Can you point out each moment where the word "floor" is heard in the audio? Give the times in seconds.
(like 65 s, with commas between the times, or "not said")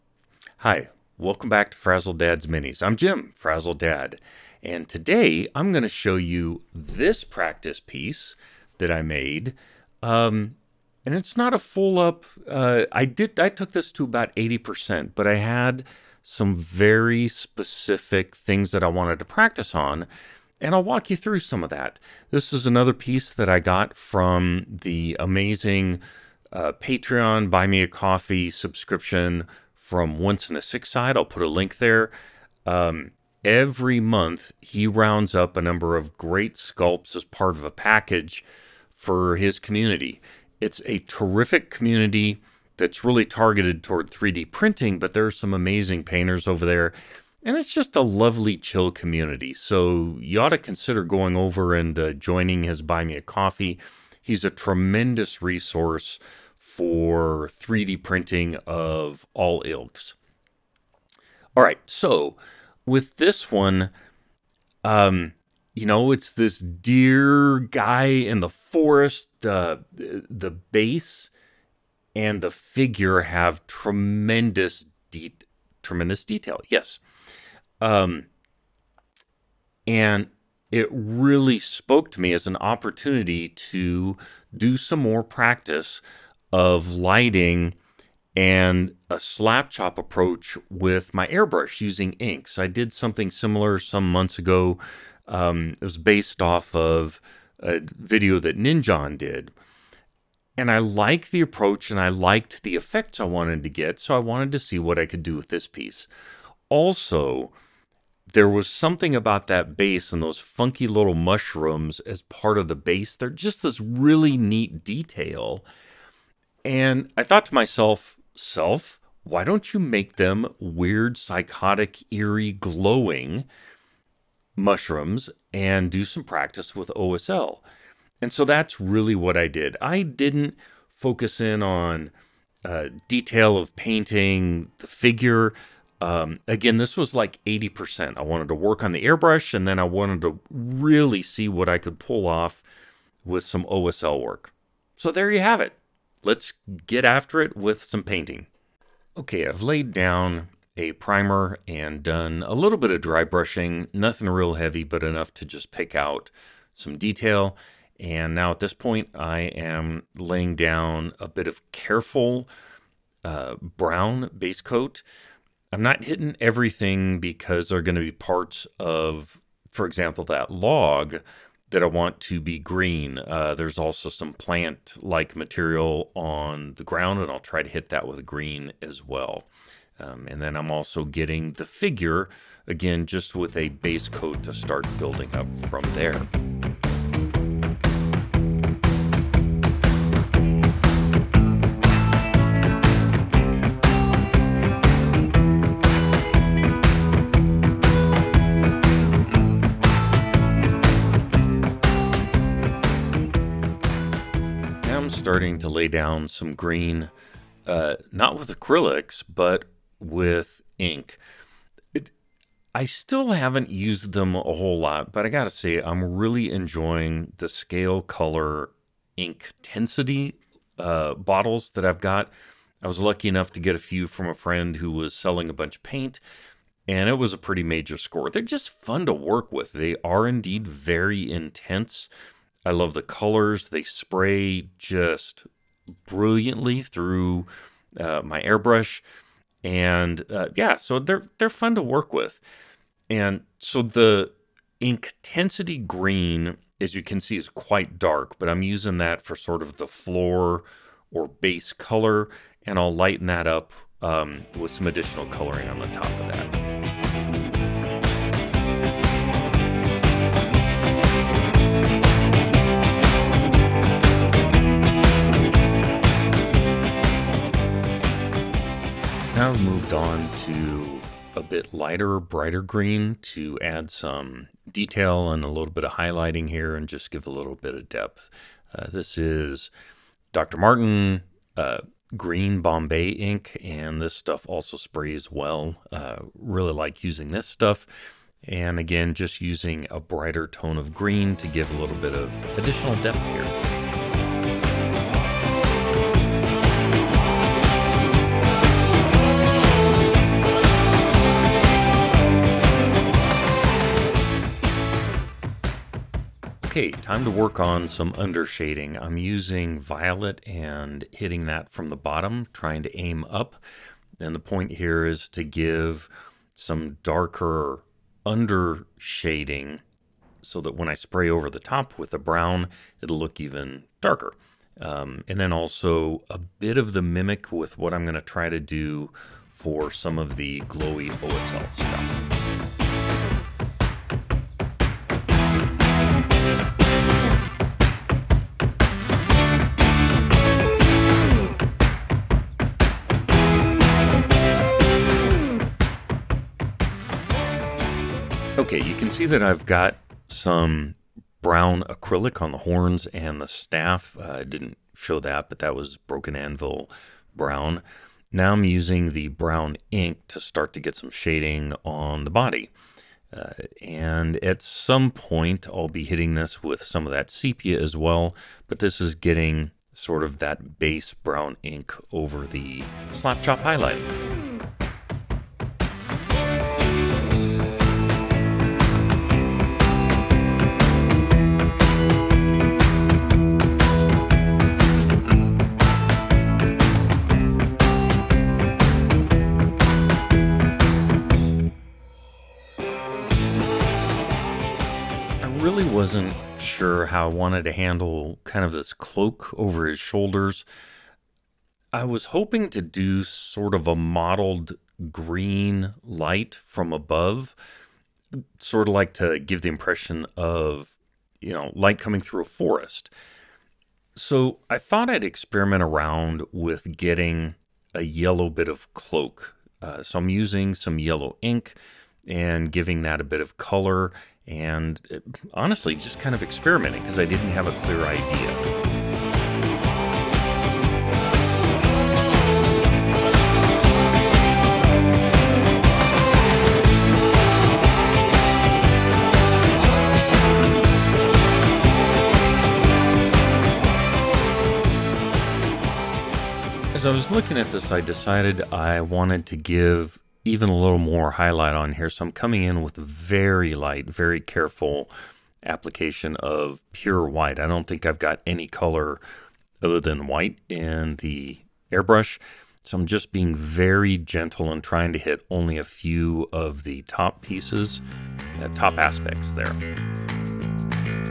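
249 s.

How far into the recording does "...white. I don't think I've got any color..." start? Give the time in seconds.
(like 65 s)
457 s.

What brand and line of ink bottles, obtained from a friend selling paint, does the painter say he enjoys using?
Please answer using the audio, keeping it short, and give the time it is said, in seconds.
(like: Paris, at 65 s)
Scale Color Ink Intensity, at 217 s.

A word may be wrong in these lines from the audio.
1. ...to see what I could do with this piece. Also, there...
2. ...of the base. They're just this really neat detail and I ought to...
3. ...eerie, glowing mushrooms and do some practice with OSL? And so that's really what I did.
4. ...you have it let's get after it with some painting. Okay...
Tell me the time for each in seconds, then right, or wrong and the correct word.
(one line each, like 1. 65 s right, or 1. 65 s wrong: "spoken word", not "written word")
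1. 104 s right
2. 112 s wrong: "thought", not "ought"
3. 122 s right
4. 145 s right.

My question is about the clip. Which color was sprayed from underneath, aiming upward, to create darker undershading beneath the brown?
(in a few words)
Violet.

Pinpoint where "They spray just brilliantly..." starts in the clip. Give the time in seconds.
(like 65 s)
233 s.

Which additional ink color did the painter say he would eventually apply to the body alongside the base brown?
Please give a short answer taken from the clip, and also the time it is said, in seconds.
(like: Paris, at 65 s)
Sepia, at 367 s.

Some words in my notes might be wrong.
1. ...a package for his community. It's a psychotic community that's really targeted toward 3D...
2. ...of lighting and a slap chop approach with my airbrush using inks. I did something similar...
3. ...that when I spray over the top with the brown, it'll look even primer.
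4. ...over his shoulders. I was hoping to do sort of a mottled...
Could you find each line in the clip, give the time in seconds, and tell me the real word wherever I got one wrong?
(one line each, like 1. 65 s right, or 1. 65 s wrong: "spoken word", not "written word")
1. 37 s wrong: "terrific", not "psychotic"
2. 86 s right
3. 320 s wrong: "darker", not "primer"
4. 399 s right.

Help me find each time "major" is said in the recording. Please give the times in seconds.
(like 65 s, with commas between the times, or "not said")
227 s.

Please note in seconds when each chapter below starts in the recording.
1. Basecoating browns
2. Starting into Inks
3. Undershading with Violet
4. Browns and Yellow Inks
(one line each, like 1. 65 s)
1. 148 s
2. 203 s
3. 305 s
4. 347 s.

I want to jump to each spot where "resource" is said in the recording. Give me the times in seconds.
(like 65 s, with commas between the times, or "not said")
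55 s.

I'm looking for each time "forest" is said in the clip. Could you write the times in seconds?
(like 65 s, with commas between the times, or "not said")
68 s, 412 s.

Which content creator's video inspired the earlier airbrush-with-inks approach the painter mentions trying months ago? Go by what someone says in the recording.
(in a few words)
Ninjon.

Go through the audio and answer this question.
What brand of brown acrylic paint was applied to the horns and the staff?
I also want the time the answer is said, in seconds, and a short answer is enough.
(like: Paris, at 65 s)
Broken Anvil, at 355 s.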